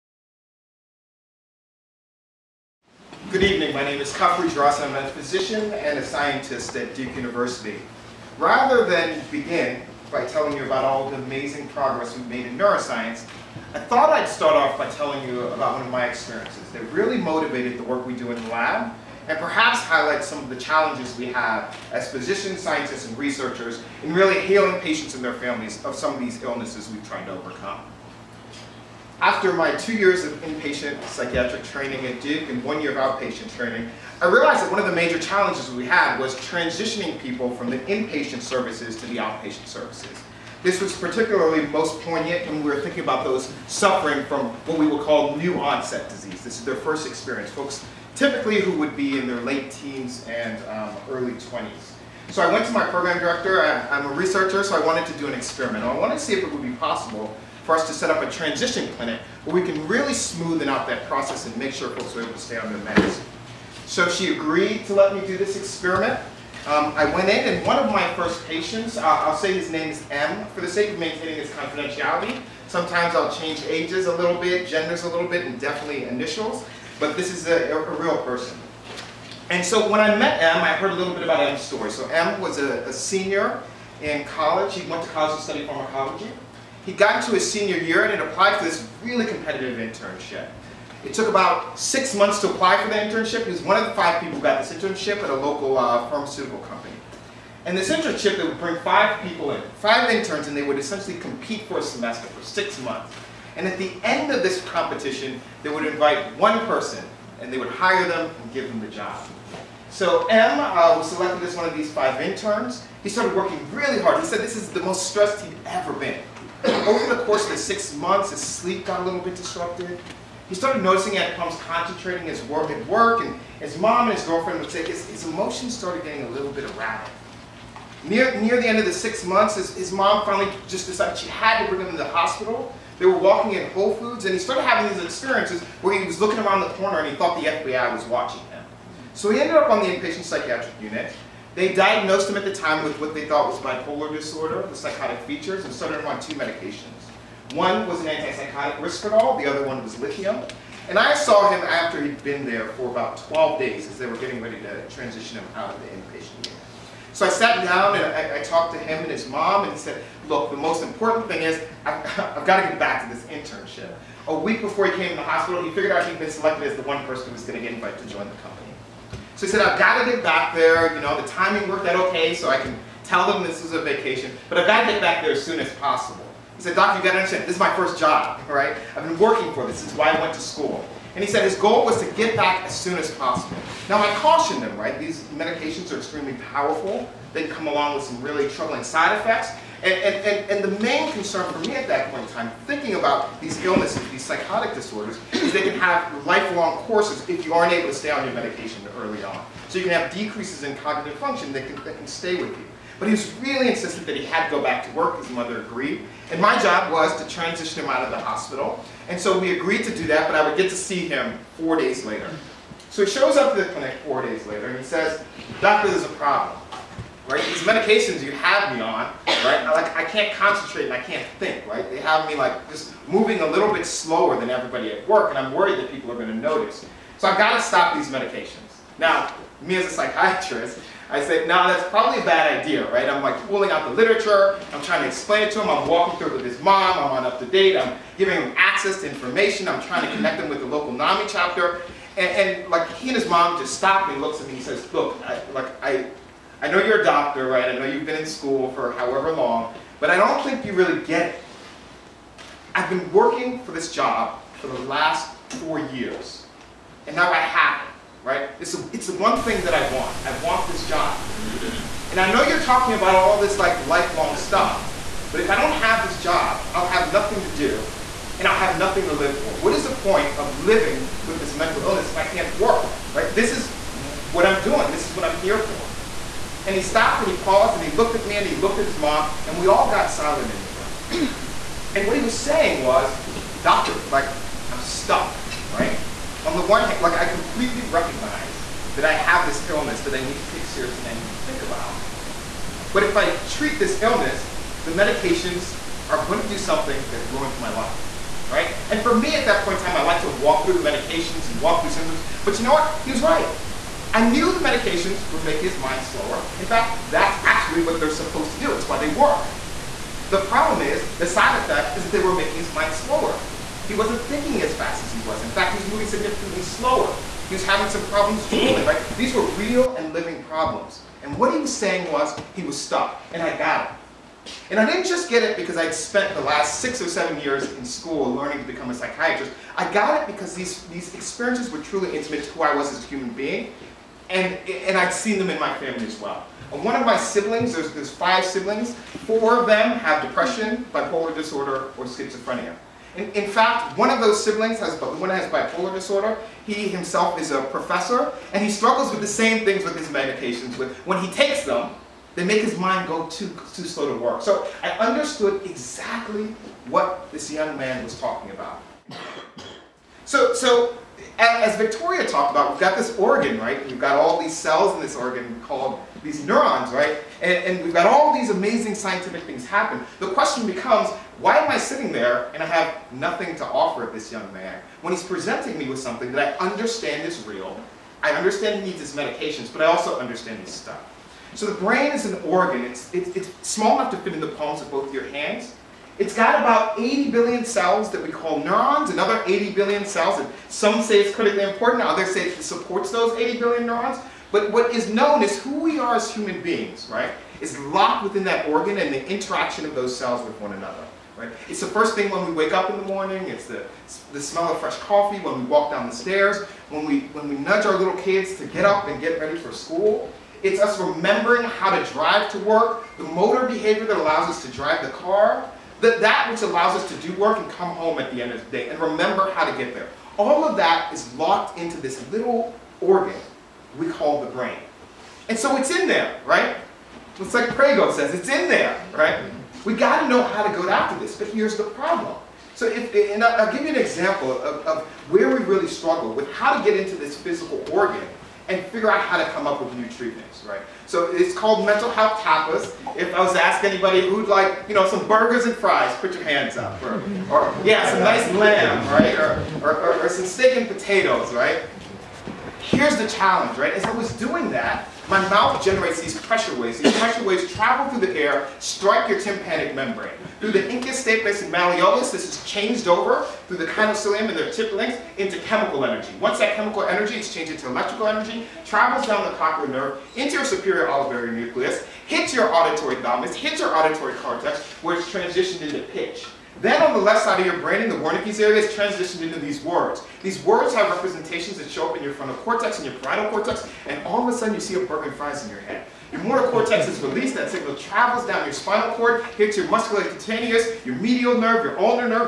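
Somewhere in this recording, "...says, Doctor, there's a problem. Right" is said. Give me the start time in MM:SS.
03:34.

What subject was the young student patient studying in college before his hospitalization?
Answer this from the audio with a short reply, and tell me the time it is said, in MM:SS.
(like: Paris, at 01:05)
pharmacology, at 01:25.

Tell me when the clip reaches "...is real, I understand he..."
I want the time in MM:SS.
06:17.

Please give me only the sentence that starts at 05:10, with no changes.
The problem is, the side effect is that they were making his mind slower.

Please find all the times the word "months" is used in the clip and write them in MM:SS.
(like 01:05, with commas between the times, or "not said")
01:32, 01:42, 01:57, 02:09.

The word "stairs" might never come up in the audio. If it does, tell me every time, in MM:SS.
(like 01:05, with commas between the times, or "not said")
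06:46.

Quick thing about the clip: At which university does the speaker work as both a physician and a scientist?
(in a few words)
Duke University.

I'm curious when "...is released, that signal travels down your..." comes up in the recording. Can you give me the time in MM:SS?
08:07.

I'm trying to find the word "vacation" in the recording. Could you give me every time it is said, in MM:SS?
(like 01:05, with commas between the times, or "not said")
02:53.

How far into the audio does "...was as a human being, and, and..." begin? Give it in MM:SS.
05:32.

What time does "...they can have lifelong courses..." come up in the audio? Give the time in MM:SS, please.
03:15.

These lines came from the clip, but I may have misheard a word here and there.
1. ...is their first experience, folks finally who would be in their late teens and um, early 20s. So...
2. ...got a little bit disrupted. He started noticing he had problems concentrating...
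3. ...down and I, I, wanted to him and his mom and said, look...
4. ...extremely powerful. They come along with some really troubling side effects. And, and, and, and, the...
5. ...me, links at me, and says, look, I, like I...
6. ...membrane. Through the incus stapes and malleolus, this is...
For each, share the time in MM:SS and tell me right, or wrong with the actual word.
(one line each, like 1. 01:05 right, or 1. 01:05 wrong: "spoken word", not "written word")
1. 00:46 wrong: "typically", not "finally"
2. 01:58 right
3. 02:37 wrong: "talked", not "wanted"
4. 03:05 right
5. 04:04 wrong: "looks", not "links"
6. 07:39 right.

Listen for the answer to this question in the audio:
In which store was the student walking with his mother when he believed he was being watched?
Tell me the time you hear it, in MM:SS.
02:13.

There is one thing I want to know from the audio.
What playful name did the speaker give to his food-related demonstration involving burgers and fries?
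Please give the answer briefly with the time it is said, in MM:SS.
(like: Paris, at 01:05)
mental health tapas, at 07:21.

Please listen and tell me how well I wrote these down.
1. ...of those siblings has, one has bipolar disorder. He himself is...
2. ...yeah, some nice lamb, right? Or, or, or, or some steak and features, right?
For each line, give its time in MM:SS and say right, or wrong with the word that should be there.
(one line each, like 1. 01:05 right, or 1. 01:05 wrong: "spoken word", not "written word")
1. 05:44 right
2. 07:27 wrong: "potatoes", not "features".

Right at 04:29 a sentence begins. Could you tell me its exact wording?
What is the point of living with this mental illness if I can't work, right?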